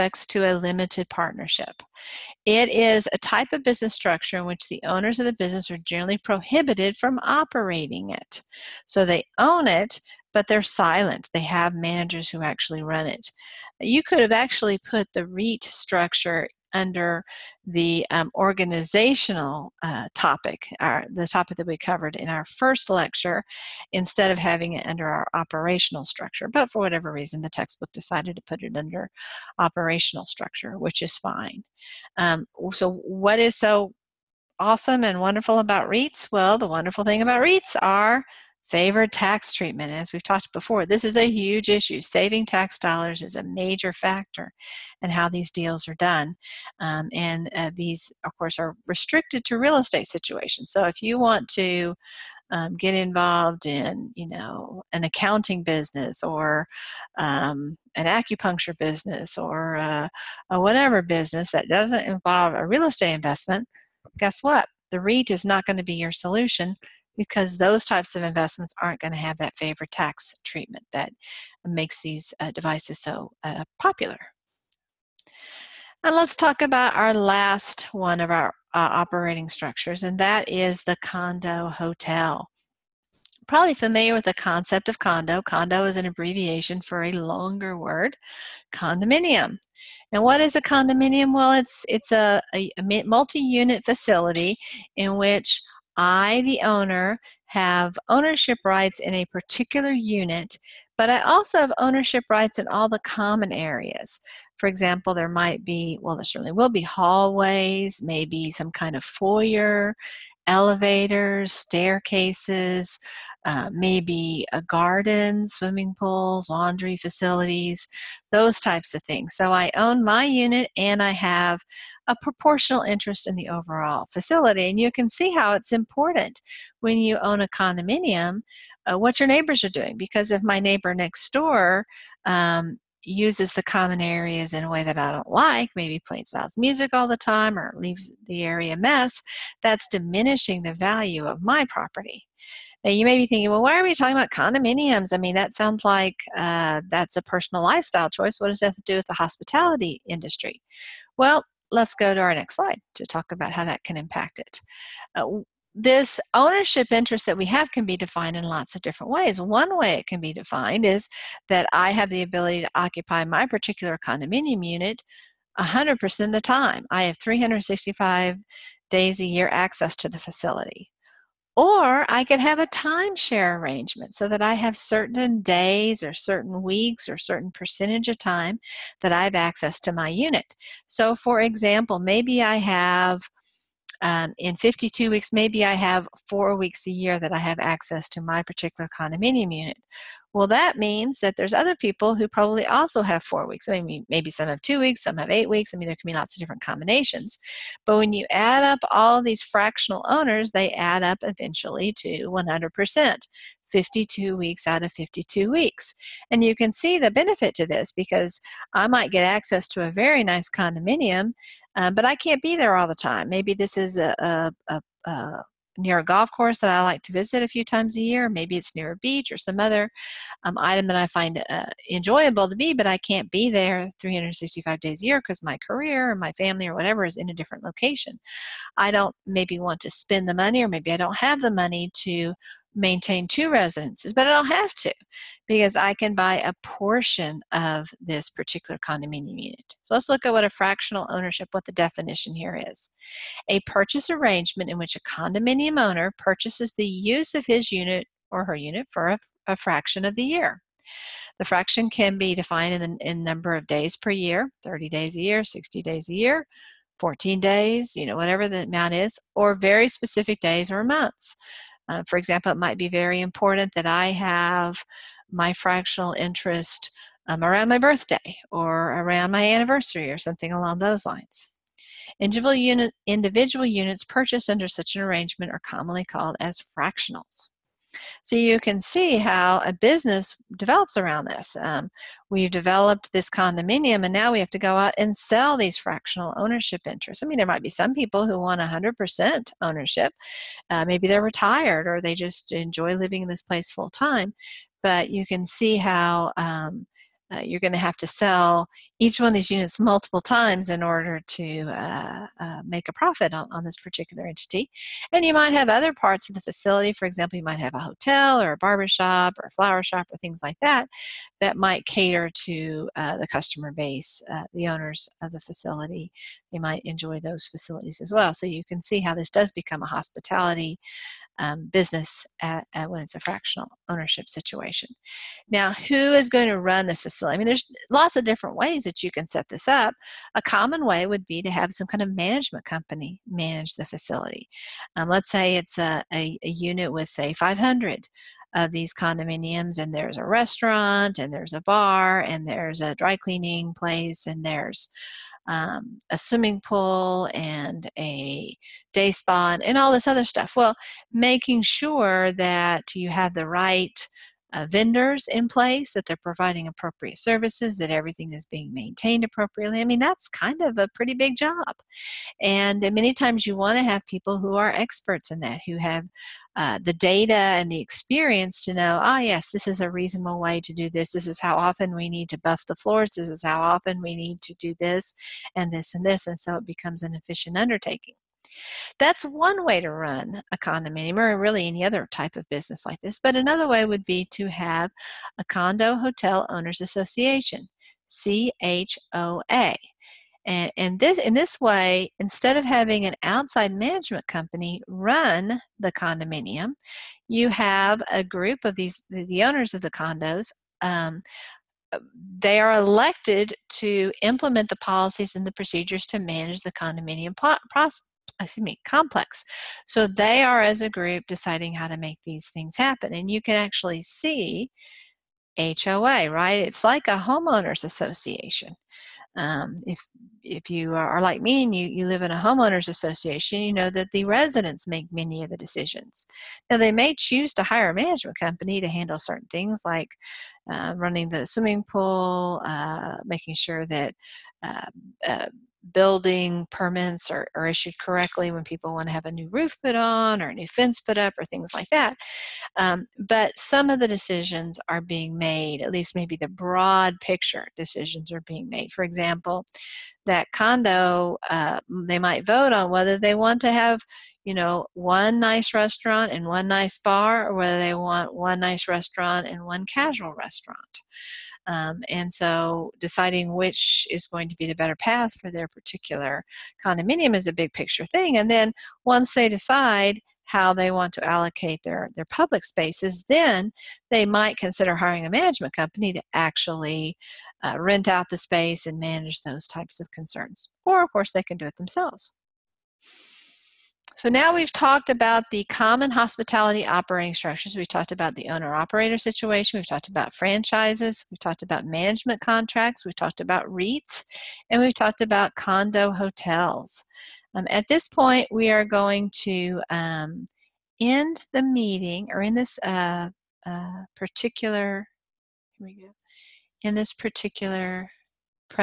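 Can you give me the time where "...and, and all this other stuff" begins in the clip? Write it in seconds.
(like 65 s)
349 s.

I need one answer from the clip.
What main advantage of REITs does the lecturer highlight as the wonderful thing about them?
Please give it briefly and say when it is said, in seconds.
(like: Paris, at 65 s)
Favored tax treatment, at 38 s.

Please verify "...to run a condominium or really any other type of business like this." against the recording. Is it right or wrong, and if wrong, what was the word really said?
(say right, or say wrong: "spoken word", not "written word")
right.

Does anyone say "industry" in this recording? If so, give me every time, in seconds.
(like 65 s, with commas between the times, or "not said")
150 s.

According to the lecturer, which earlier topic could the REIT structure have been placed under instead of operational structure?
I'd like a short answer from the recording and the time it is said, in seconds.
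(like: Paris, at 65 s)
organizational, at 18 s.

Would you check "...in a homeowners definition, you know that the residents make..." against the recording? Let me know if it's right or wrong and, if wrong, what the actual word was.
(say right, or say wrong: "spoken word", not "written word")
wrong: "association", not "definition".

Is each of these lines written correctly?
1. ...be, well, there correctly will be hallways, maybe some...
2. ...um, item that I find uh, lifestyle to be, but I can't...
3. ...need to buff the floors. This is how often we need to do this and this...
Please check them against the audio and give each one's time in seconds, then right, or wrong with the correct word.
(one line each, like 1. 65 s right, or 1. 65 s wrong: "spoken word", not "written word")
1. 105 s wrong: "certainly", not "correctly"
2. 220 s wrong: "enjoyable", not "lifestyle"
3. 372 s right.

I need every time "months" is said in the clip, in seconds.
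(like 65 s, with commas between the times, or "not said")
260 s.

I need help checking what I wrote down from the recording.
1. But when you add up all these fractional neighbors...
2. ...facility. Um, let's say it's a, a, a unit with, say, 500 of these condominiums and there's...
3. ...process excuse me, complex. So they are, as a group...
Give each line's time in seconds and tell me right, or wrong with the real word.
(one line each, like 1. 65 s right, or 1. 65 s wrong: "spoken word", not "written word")
1. 197 s wrong: "owners", not "neighbors"
2. 333 s right
3. 407 s right.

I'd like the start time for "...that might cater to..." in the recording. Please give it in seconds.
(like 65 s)
311 s.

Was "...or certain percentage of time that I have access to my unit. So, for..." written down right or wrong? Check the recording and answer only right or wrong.
right.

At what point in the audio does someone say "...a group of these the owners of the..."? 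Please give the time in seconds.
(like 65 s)
398 s.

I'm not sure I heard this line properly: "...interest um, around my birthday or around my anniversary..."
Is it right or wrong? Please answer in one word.
right.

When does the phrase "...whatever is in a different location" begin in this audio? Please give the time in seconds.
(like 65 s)
226 s.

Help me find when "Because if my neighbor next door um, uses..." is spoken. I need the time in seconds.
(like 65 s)
129 s.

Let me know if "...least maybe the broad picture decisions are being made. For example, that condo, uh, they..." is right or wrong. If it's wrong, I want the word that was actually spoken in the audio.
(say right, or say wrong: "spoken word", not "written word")
right.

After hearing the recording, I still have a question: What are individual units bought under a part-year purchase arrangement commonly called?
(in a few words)
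fractionals.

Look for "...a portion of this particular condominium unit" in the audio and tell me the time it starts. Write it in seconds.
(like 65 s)
236 s.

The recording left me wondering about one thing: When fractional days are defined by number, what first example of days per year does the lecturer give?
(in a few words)
30 days.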